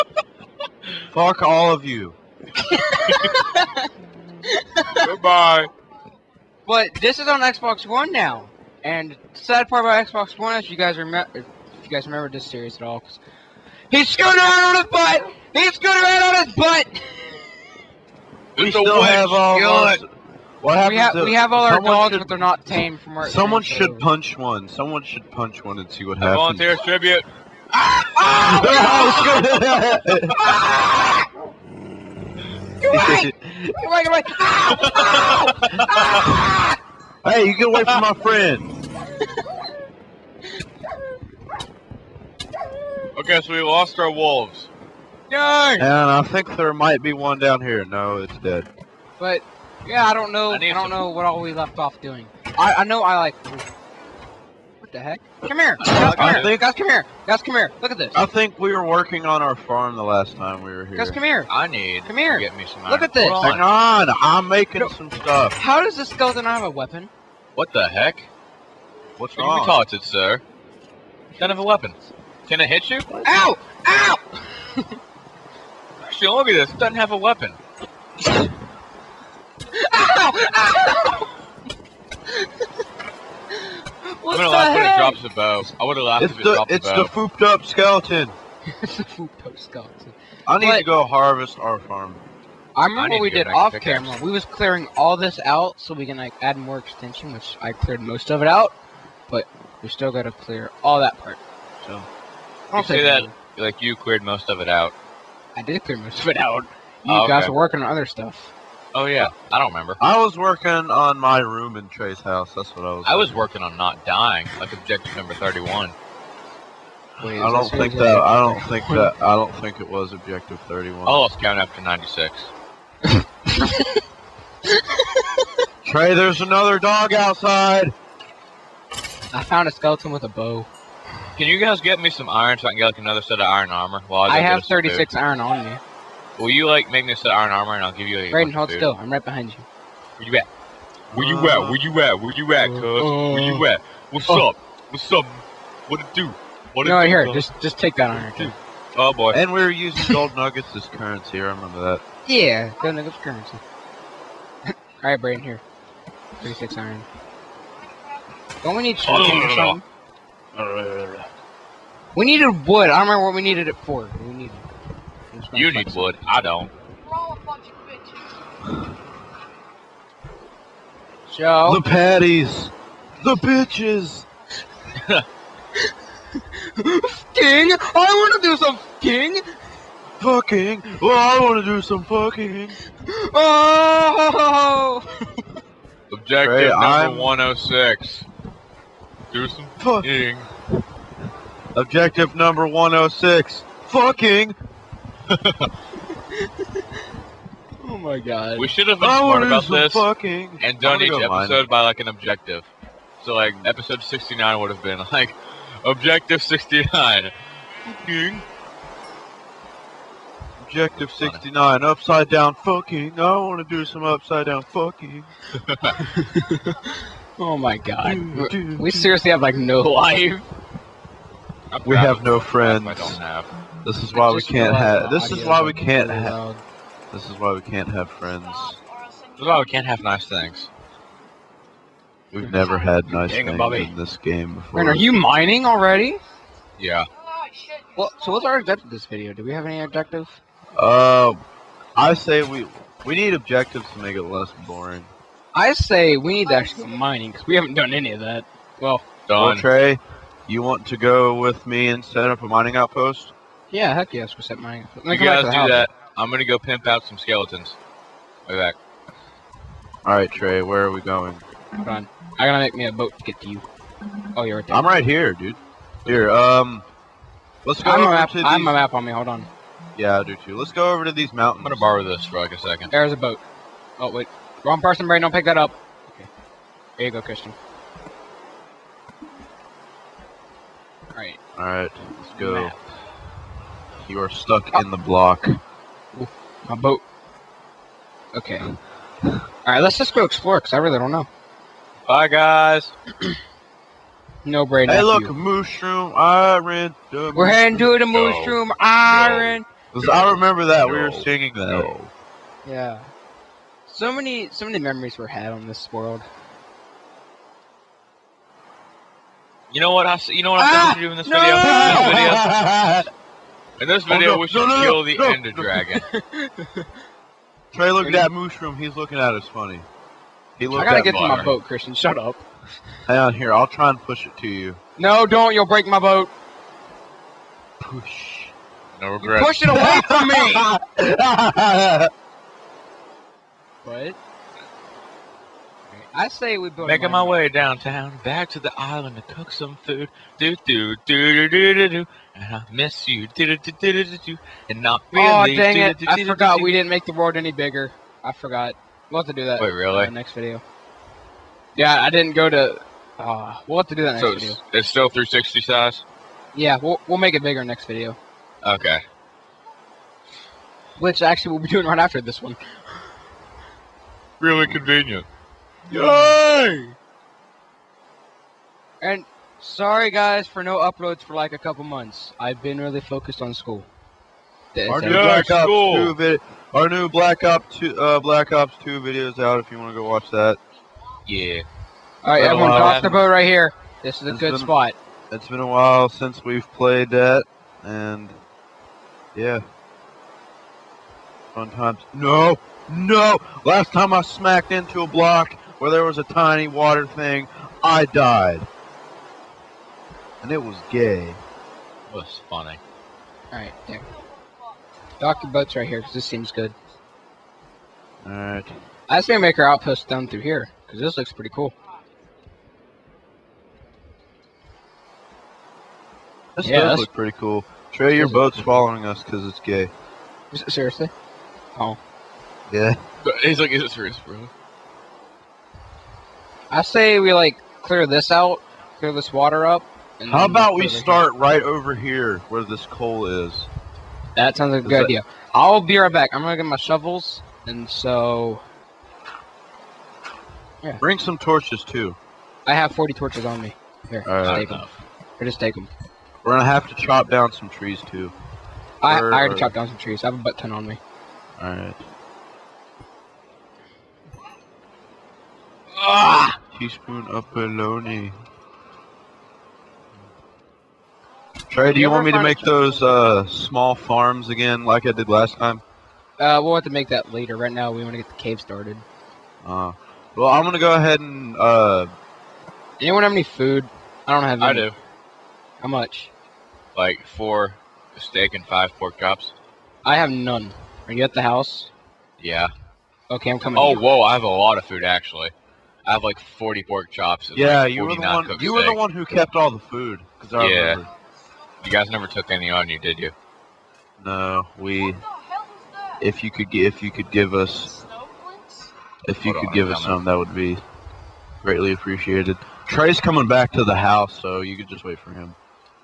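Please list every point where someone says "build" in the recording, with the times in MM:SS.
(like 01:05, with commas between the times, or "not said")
05:36.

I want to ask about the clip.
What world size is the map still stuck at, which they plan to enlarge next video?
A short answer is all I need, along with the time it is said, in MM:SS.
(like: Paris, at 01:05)
360, at 05:55.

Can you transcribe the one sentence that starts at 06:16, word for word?
2 vid- our new Black Ops 2 uh, Black Ops 2 videos out if you want to go watch that.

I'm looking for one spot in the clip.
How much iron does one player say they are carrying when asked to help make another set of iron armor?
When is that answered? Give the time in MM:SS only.
02:14.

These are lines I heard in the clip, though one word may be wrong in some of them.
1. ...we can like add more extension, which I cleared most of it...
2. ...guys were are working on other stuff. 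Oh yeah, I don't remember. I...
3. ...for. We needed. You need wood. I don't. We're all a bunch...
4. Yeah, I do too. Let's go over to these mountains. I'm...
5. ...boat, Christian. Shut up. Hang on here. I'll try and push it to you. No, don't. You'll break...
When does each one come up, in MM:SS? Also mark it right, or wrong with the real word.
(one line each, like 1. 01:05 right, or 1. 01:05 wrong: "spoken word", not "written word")
1. 01:35 right
2. 01:47 right
3. 02:43 right
4. 04:29 right
5. 05:21 right.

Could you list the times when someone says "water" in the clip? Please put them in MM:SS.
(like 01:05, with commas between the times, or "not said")
06:36, 07:09.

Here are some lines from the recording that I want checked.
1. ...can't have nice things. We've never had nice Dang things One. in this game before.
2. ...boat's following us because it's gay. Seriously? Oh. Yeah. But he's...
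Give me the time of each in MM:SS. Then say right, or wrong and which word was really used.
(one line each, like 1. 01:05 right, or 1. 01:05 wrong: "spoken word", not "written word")
1. 03:49 wrong: "Bobby", not "One"
2. 06:58 right.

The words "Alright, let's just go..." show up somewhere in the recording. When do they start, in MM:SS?
04:49.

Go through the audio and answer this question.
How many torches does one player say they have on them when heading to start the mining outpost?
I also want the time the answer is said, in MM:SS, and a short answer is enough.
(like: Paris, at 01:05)
40, at 07:22.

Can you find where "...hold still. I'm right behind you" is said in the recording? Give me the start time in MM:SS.
02:18.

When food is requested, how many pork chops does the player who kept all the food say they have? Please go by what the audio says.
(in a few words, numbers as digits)
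40.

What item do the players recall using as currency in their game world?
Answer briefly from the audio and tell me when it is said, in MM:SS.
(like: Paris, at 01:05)
Gold nuggets, at 02:32.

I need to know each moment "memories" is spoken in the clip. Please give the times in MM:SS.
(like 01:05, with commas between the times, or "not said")
05:04.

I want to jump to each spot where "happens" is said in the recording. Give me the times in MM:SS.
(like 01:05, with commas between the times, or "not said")
00:20, 00:26.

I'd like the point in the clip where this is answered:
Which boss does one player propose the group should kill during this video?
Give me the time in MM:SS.
05:15.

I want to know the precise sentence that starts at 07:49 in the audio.
Uh, well, I'm going to go ahead and...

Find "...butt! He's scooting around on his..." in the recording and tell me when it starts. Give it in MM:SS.
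00:14.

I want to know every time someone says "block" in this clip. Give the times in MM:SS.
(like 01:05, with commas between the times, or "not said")
04:44, 06:35.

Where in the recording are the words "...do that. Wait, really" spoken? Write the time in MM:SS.
05:49.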